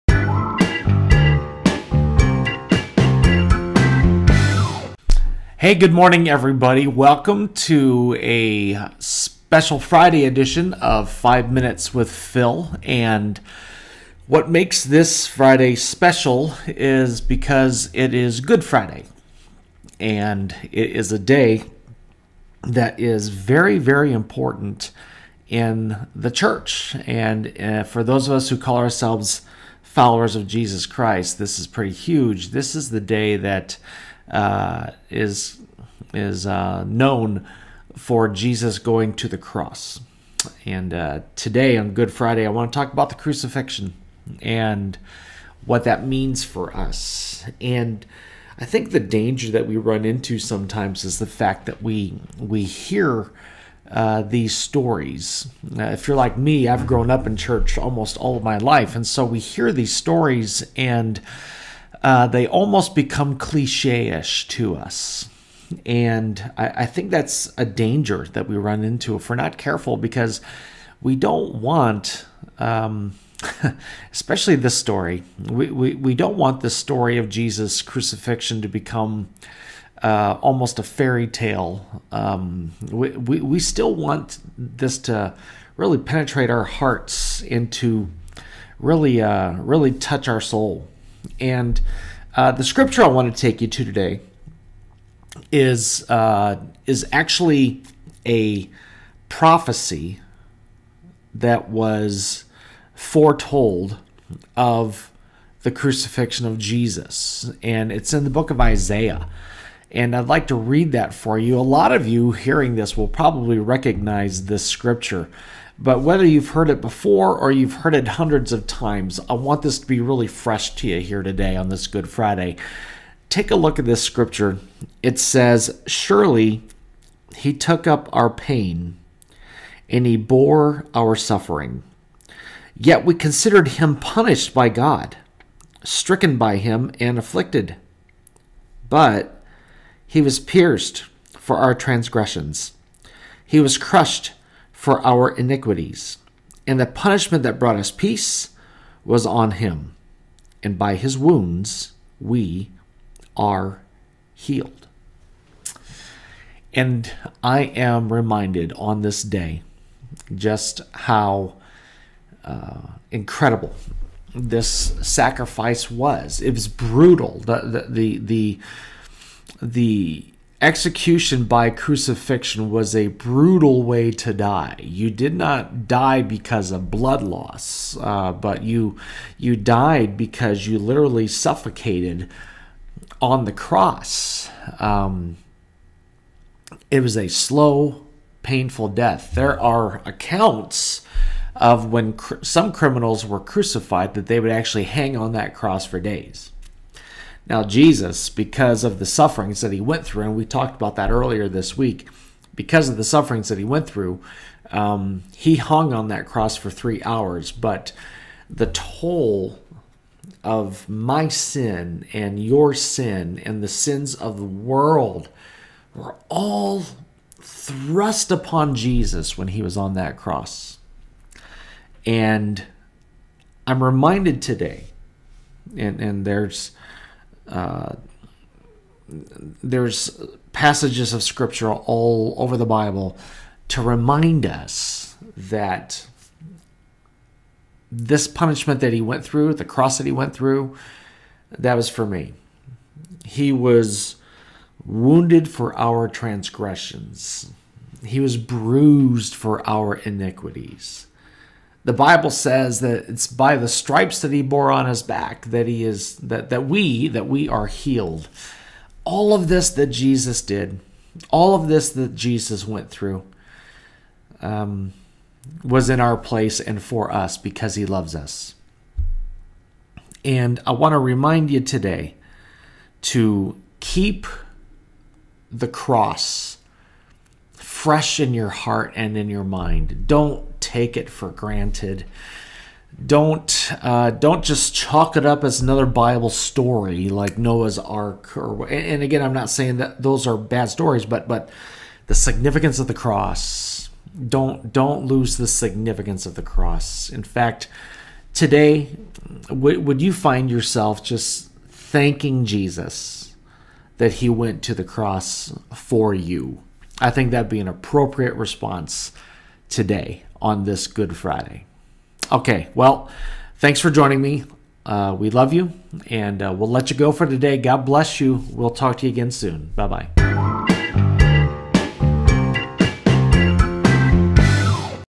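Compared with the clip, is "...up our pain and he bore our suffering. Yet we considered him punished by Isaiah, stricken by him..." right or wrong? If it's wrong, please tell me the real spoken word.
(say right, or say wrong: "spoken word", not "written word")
wrong: "God", not "Isaiah".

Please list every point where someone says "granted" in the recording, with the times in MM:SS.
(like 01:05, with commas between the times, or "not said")
04:41.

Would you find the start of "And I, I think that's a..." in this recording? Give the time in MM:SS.
01:05.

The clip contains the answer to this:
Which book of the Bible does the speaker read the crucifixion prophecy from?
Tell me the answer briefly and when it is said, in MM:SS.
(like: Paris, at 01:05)
Isaiah, at 01:48.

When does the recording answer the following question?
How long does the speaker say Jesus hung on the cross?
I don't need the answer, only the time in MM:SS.
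03:26.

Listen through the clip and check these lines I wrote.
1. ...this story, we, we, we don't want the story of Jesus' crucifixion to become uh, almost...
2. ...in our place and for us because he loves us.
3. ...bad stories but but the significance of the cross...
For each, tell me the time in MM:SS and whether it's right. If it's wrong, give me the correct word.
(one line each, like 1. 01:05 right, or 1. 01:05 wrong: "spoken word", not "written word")
1. 01:14 right
2. 04:25 right
3. 04:50 right.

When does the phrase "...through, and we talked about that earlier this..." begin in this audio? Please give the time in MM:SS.
03:20.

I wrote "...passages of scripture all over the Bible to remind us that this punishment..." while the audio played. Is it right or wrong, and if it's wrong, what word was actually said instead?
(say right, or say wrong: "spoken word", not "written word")
right.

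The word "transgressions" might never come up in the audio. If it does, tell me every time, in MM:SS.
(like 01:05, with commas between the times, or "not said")
02:21, 04:06.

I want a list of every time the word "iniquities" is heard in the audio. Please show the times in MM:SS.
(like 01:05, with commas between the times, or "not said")
02:25, 04:09.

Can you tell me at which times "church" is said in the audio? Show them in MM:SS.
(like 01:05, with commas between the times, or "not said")
00:26, 00:57.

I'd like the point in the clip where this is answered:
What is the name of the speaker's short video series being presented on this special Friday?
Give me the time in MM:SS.
00:11.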